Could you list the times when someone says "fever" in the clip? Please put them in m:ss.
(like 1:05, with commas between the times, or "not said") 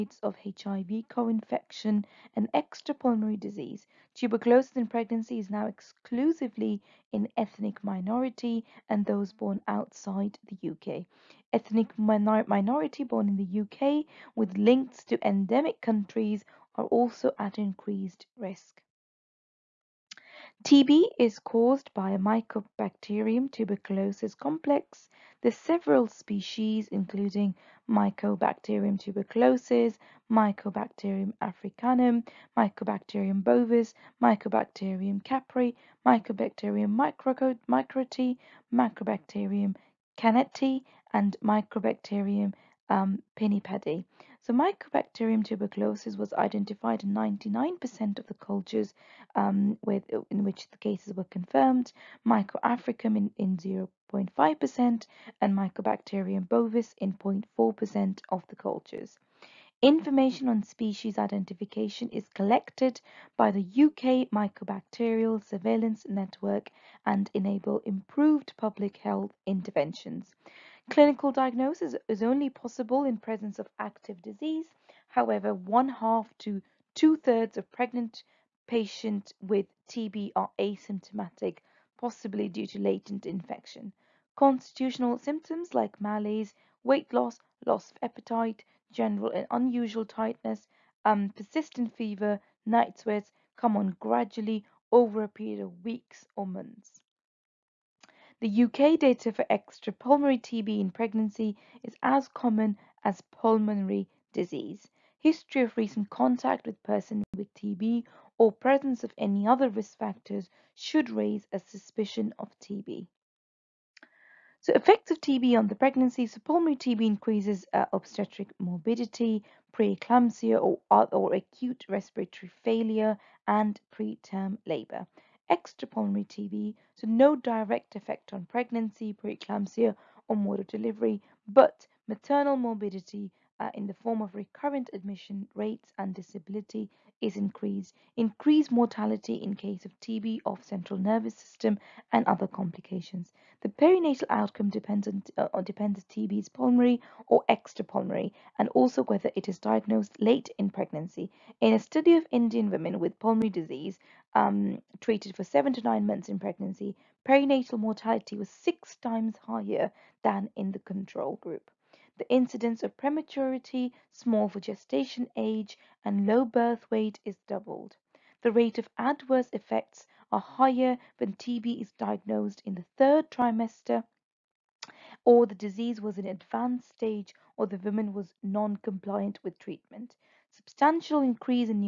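1:31.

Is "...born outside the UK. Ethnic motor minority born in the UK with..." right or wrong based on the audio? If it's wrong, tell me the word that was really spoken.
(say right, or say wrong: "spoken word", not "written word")
wrong: "minor", not "motor".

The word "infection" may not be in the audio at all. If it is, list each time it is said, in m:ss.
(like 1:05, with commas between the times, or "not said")
0:01, 1:23.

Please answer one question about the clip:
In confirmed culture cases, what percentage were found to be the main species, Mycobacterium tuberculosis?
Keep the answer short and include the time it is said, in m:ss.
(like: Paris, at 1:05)
99%, at 0:47.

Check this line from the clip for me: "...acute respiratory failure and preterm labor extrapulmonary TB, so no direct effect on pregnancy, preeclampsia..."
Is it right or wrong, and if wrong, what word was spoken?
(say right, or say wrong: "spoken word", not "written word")
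right.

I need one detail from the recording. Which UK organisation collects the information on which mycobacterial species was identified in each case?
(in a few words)
UK Mycobacterial Surveillance Network.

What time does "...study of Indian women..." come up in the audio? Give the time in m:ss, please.
2:31.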